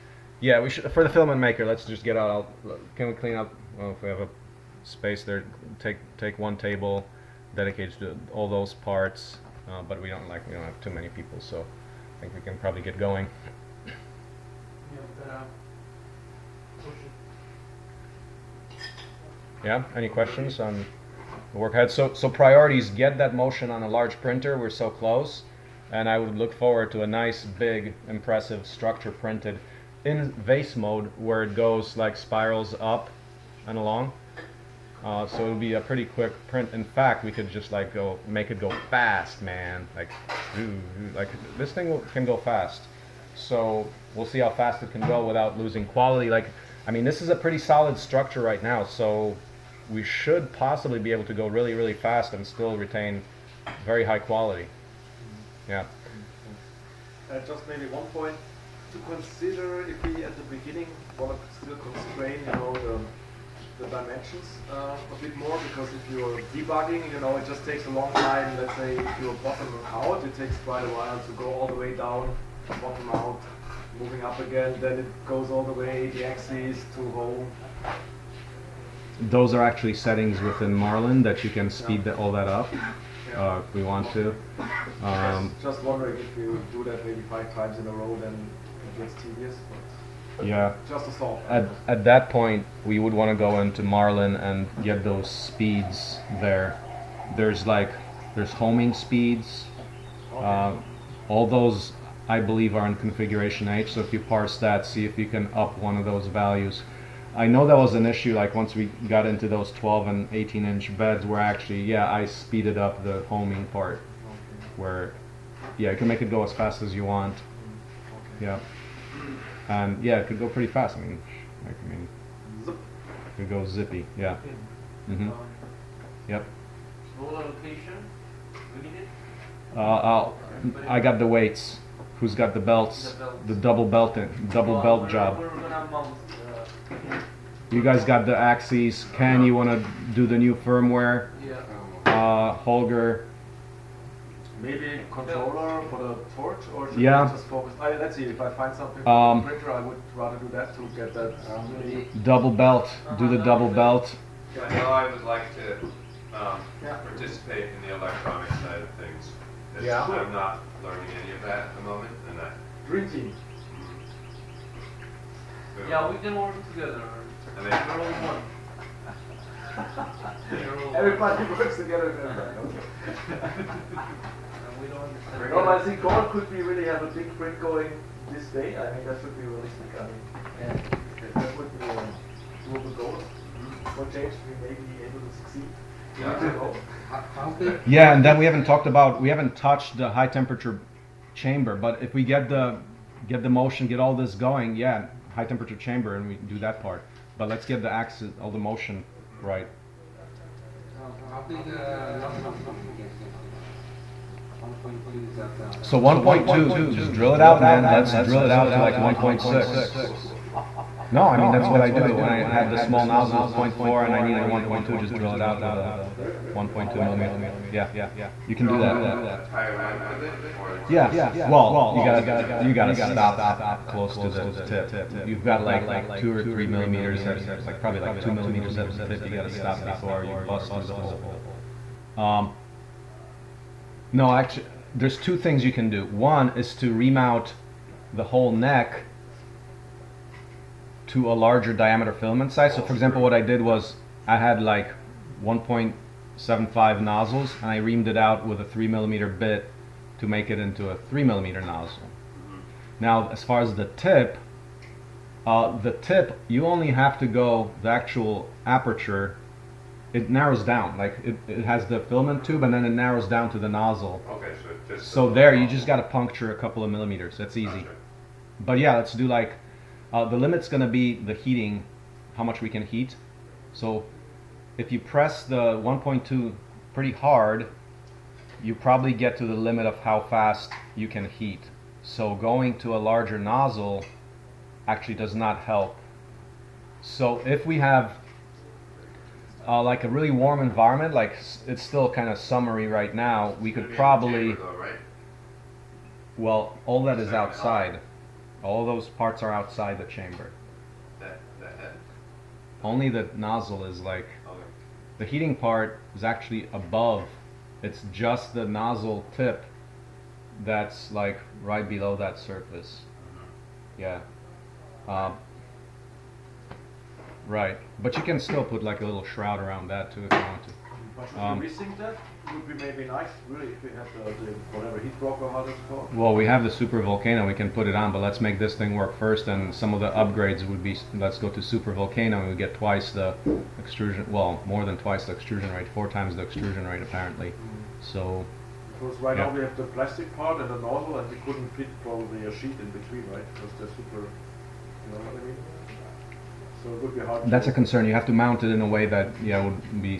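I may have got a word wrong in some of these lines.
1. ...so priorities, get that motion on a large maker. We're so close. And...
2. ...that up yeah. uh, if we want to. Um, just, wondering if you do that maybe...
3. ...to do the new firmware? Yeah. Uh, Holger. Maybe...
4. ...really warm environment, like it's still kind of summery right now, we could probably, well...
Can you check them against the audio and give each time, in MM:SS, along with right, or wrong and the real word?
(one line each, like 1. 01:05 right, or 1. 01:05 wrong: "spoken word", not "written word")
1. 00:22 wrong: "printer", not "maker"
2. 01:22 right
3. 02:19 right
4. 04:50 right.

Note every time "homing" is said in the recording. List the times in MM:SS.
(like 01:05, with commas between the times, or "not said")
01:38, 01:53.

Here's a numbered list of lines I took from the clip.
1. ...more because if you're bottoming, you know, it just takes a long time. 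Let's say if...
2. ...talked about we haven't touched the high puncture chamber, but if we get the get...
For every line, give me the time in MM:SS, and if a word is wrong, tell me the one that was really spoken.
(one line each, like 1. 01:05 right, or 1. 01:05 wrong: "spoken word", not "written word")
1. 01:05 wrong: "debugging", not "bottoming"
2. 03:08 wrong: "temperature", not "puncture".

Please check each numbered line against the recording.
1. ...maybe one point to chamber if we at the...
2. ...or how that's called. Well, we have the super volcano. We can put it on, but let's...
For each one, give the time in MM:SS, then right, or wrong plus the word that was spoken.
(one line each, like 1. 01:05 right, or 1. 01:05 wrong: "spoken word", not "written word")
1. 00:57 wrong: "consider", not "chamber"
2. 05:25 right.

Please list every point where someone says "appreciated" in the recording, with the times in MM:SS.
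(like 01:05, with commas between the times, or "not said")
not said.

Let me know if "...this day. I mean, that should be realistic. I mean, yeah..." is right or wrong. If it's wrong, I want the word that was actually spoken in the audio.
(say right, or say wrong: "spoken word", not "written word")
right.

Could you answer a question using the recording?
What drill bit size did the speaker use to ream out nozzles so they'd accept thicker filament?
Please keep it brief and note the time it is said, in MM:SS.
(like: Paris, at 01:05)
3 millimeter, at 04:08.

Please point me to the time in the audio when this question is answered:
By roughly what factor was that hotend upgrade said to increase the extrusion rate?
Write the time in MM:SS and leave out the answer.
05:35.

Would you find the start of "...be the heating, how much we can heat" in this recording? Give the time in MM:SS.
04:30.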